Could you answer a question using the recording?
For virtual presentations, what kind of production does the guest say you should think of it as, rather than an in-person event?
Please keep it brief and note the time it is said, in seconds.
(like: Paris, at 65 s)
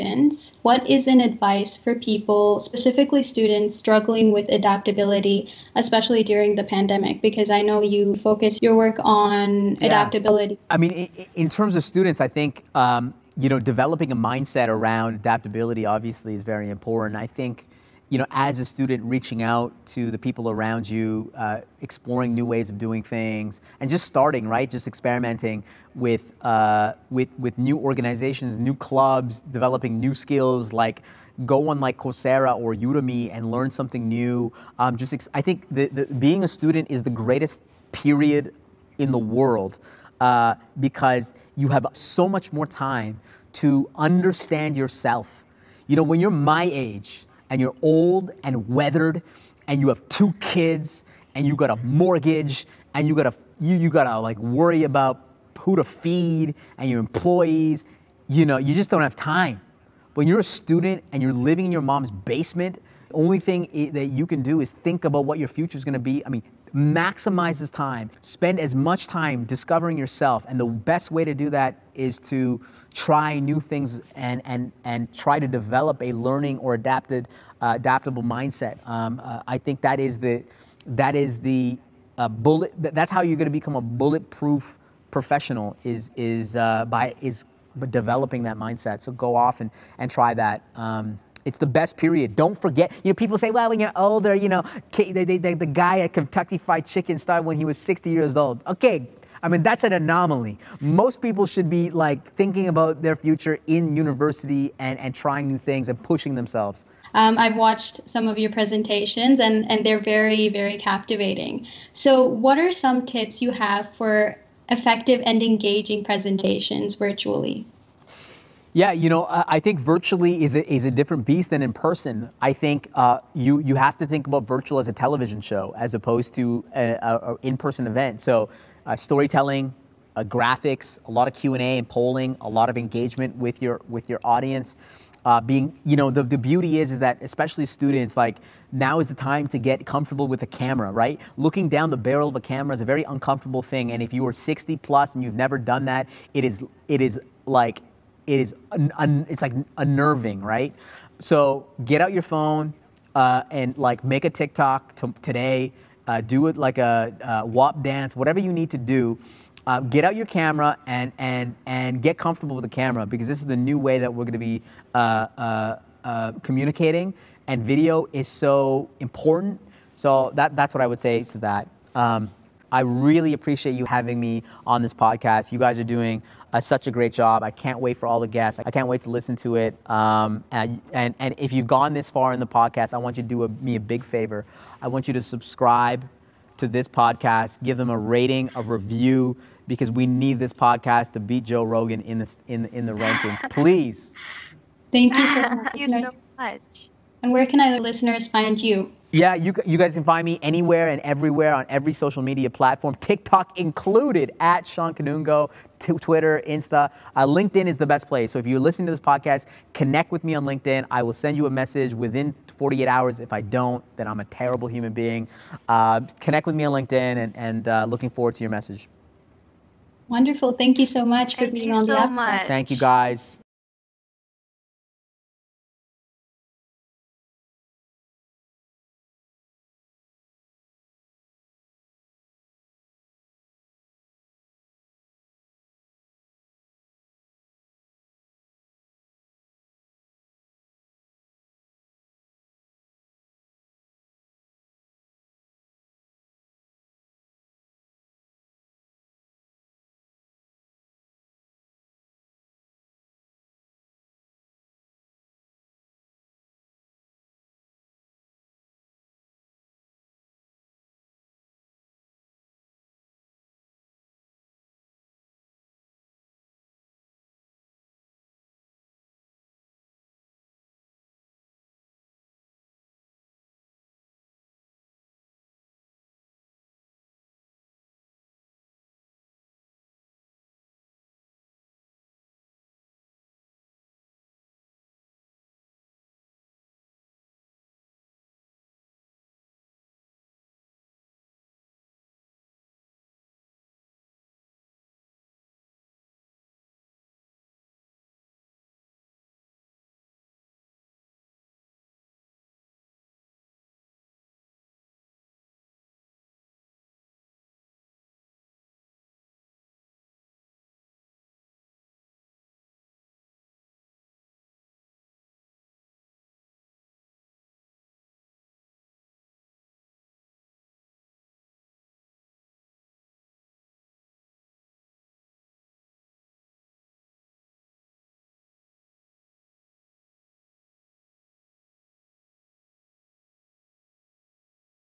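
A television show, at 124 s.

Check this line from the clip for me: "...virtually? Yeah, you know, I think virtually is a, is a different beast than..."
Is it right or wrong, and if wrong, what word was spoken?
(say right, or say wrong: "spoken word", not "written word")
right.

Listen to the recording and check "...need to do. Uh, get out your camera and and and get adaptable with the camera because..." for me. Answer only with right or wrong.
wrong.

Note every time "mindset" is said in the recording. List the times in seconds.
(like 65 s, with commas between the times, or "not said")
14 s, 78 s, 88 s.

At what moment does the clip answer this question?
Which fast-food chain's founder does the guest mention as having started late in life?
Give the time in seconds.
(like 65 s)
96 s.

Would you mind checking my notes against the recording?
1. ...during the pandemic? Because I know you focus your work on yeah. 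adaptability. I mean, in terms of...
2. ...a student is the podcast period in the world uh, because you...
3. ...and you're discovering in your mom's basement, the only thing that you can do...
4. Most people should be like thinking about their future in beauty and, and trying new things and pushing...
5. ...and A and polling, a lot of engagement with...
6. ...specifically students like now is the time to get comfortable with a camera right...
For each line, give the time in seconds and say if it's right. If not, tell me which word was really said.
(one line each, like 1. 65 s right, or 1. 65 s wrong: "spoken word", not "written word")
1. 6 s right
2. 36 s wrong: "greatest", not "podcast"
3. 61 s wrong: "living", not "discovering"
4. 100 s wrong: "university", not "beauty"
5. 131 s right
6. 137 s wrong: "especially", not "specifically".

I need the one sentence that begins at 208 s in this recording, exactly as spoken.
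So if you're listening to this podcast, connect with me on LinkedIn.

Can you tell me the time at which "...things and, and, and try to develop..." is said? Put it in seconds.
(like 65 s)
73 s.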